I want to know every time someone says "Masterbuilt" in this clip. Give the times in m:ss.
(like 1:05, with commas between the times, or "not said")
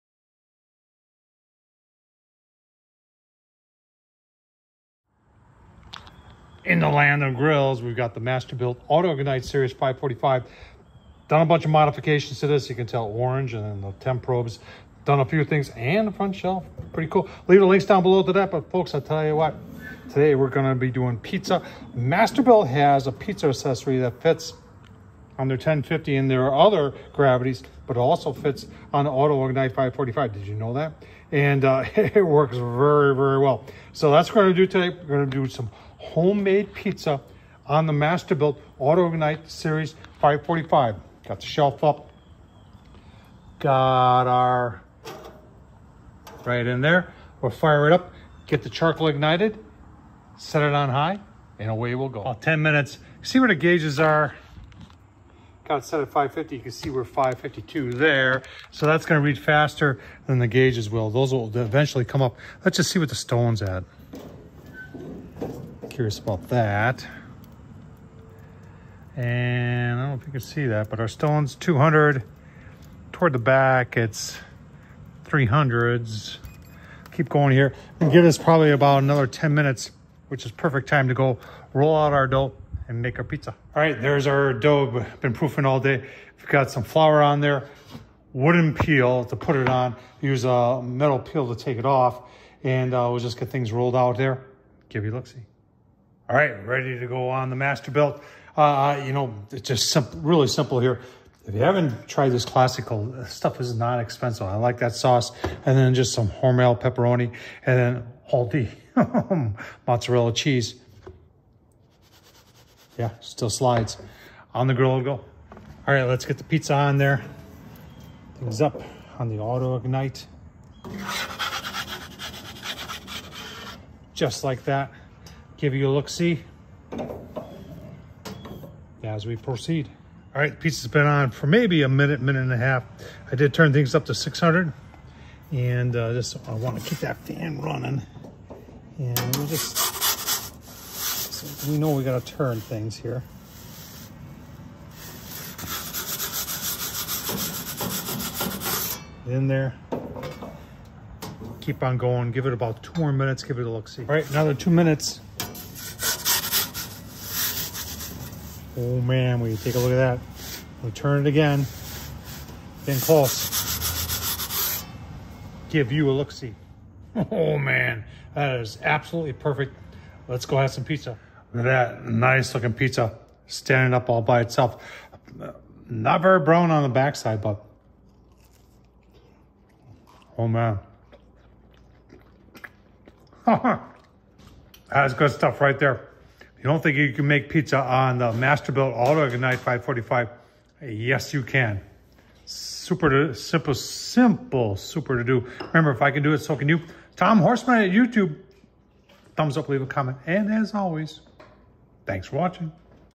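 0:08, 0:21, 0:37, 1:37, 3:08.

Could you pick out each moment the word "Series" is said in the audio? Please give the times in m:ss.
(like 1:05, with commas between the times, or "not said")
0:09, 0:39.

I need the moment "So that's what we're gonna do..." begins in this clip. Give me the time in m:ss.
0:33.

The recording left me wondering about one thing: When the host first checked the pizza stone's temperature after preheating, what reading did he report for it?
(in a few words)
200.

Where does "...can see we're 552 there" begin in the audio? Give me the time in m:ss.
0:56.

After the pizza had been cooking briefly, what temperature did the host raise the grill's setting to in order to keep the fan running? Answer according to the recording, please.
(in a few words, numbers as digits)
600.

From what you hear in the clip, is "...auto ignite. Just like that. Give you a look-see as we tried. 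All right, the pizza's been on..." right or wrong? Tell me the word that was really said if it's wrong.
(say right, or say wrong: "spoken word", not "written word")
wrong: "proceed", not "tried".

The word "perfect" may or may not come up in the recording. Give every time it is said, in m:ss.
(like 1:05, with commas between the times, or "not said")
1:20, 2:49.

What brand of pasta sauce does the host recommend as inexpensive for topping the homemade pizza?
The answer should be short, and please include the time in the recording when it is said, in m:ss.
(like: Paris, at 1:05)
Classico, at 1:42.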